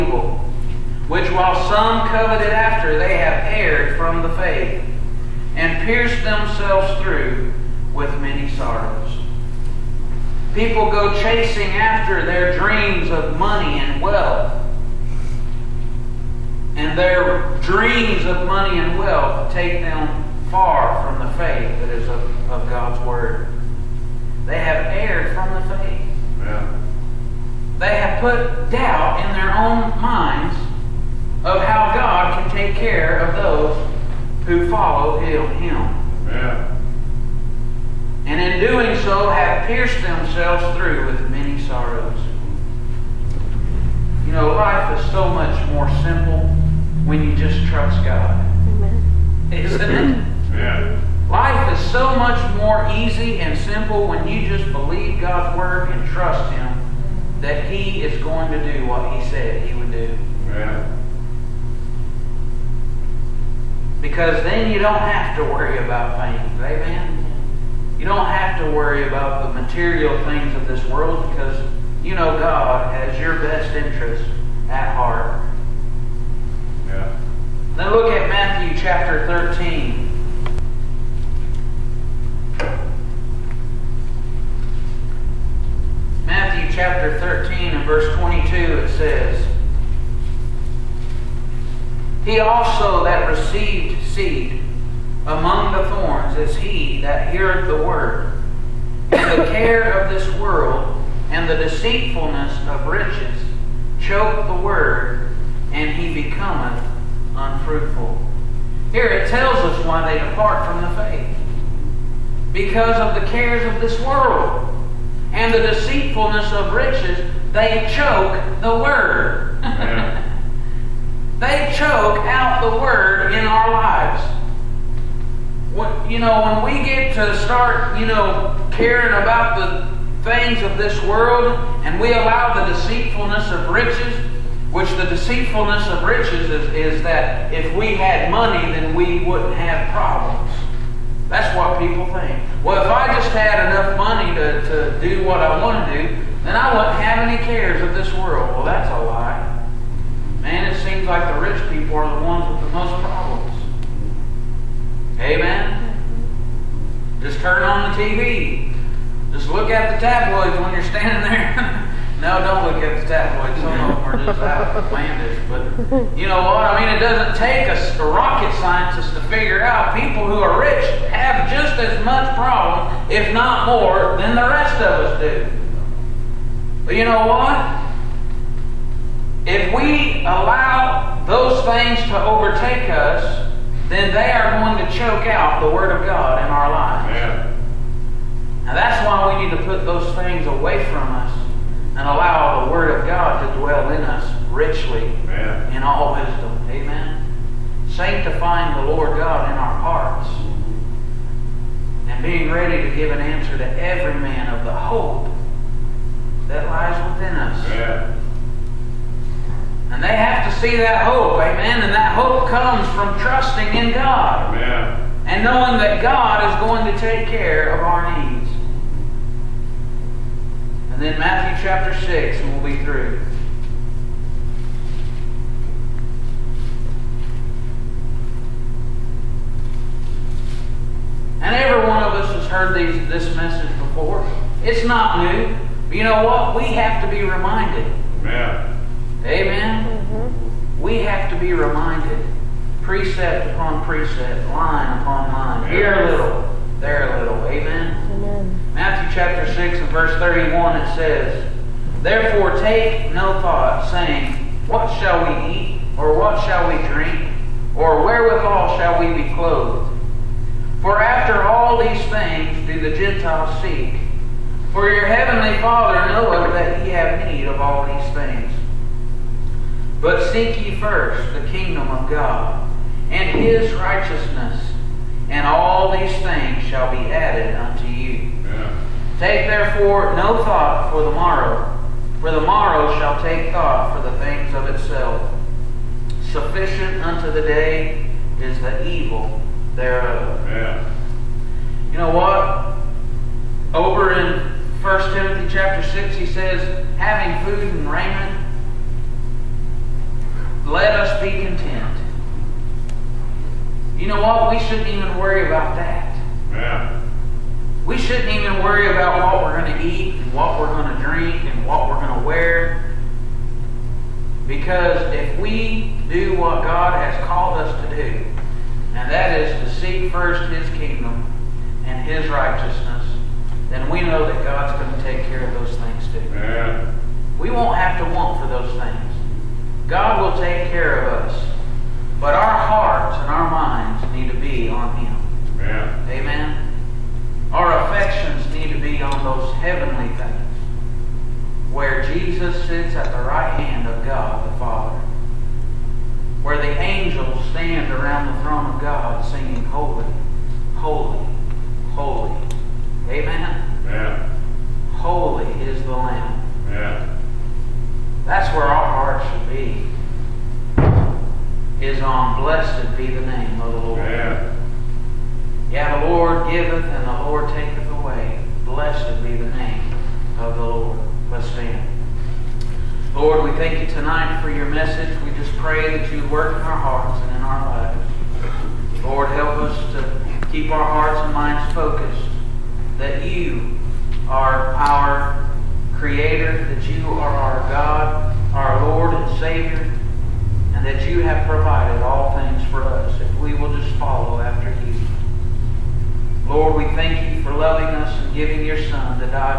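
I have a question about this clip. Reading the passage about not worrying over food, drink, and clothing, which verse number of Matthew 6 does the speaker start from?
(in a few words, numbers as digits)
31.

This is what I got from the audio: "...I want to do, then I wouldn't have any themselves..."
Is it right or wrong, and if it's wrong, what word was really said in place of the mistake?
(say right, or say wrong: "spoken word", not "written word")
wrong: "cares", not "themselves".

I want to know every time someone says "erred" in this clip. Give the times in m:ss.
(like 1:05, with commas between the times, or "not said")
0:03, 0:24.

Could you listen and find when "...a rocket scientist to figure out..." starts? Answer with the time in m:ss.
2:47.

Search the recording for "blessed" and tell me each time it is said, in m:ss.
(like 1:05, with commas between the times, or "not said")
6:02, 6:08.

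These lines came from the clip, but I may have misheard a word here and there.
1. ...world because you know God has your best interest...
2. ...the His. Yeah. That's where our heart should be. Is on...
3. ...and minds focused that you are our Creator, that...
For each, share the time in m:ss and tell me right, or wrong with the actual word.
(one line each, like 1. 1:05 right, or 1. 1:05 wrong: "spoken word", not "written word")
1. 1:10 right
2. 5:55 wrong: "Lamb", not "His"
3. 6:21 right.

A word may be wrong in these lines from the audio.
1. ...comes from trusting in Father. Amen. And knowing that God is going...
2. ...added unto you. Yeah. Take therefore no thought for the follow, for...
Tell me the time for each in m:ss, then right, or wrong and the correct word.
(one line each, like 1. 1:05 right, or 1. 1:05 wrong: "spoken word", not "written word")
1. 3:32 wrong: "God", not "Father"
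2. 4:37 wrong: "morrow", not "follow".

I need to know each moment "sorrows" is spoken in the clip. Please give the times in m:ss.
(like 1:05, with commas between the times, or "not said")
0:08, 0:41.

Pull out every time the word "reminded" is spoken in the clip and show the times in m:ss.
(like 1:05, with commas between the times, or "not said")
3:57, 4:01.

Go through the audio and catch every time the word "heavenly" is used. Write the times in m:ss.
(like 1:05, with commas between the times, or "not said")
4:25, 5:39.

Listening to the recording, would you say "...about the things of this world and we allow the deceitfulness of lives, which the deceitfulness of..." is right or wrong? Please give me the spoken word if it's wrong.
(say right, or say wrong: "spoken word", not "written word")
wrong: "riches", not "lives".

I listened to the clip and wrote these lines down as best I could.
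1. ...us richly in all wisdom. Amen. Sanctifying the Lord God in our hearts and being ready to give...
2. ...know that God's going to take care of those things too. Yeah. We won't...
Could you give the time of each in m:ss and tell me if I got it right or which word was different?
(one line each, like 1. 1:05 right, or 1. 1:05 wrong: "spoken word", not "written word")
1. 3:14 right
2. 5:24 right.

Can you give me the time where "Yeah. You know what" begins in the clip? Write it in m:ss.
4:50.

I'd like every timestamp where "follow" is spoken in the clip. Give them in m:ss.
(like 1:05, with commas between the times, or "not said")
0:34, 6:33.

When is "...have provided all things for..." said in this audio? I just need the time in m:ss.
6:31.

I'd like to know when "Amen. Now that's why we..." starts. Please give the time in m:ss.
3:07.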